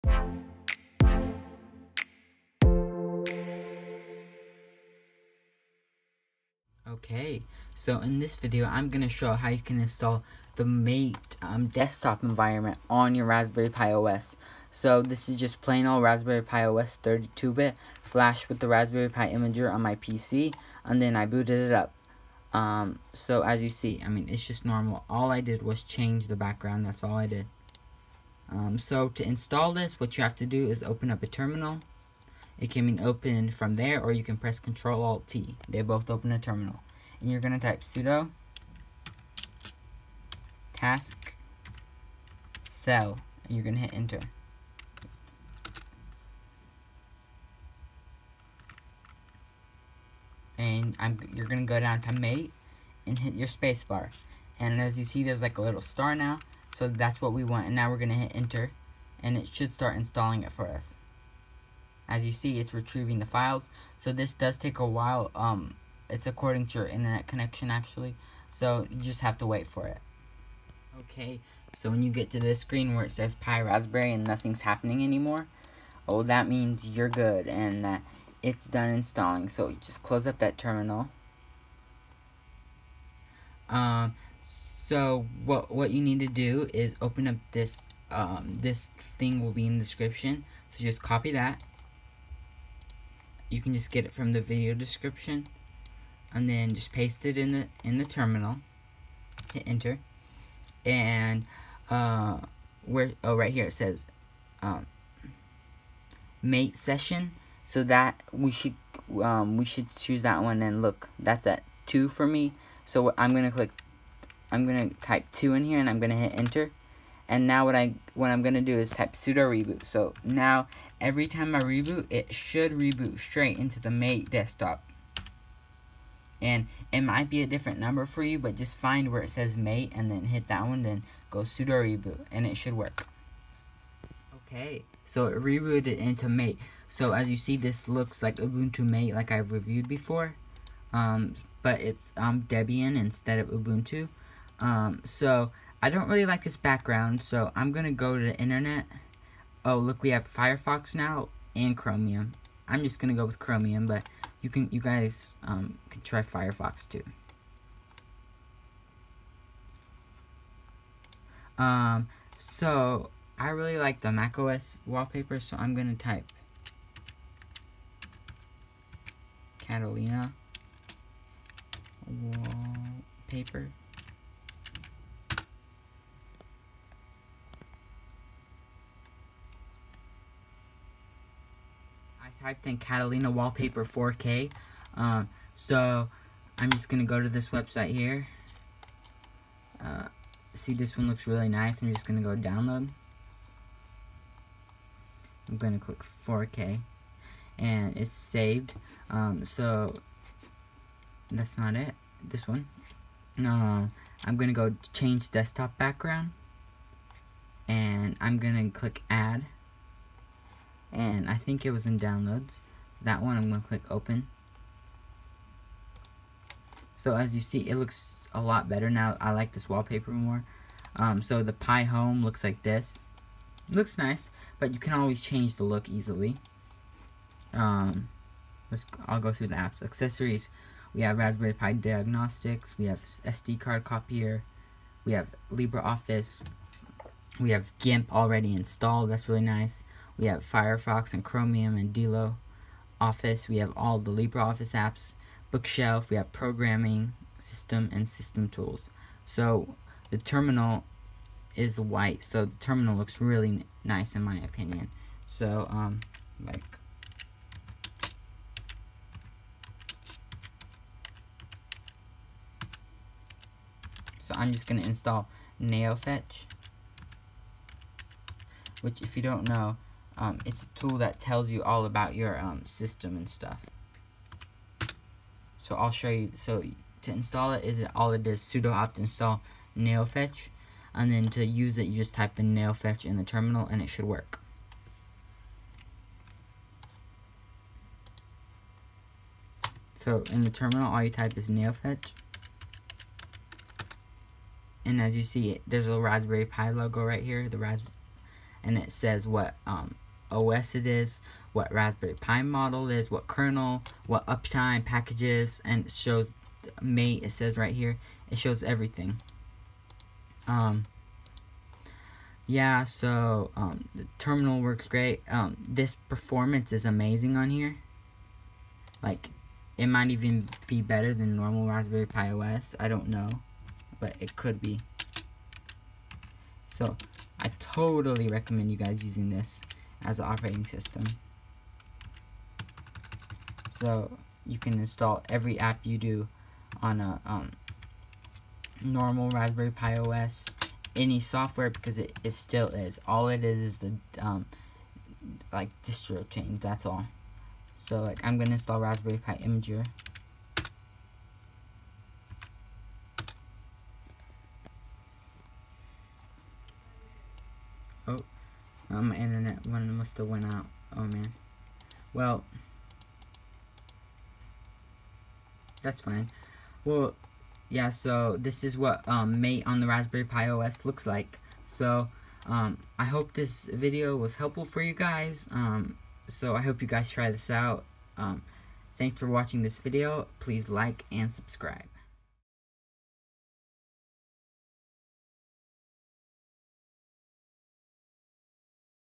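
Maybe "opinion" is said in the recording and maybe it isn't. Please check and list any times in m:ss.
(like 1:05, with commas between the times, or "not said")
4:14.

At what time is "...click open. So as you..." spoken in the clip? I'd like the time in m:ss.
3:33.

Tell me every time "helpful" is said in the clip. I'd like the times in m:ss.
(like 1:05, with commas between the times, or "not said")
6:14.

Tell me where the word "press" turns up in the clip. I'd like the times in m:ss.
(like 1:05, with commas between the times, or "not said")
0:34.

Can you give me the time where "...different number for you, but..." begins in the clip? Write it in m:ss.
2:07.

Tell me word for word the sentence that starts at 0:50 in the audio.
And I'm, you're going to go down to mate and hit your spacebar.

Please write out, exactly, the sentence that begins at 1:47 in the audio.
So that we should um, we should choose that one and look that's at two for me.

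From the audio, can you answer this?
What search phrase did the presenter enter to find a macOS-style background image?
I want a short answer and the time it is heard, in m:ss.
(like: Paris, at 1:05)
Catalina Wallpaper 4K, at 3:02.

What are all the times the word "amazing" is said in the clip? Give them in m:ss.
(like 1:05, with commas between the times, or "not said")
5:16.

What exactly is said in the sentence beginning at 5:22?
I don't know, but it could be.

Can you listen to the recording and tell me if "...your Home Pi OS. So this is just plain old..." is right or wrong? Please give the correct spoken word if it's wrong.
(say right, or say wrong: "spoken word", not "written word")
wrong: "Raspberry", not "Home".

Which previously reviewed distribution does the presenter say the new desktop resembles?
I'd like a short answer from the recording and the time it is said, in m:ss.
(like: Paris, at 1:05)
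Ubuntu MATE, at 2:18.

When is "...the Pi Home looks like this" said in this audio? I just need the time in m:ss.
3:41.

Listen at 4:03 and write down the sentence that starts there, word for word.
Office, we have all the LibreOffice apps.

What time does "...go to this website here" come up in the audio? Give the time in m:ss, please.
3:07.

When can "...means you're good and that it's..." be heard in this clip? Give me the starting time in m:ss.
1:16.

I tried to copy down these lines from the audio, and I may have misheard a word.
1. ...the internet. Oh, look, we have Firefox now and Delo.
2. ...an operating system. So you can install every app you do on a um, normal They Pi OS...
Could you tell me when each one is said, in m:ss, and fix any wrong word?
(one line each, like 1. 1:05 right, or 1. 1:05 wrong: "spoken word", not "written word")
1. 2:28 wrong: "Chromium", not "Delo"
2. 5:30 wrong: "Raspberry", not "They".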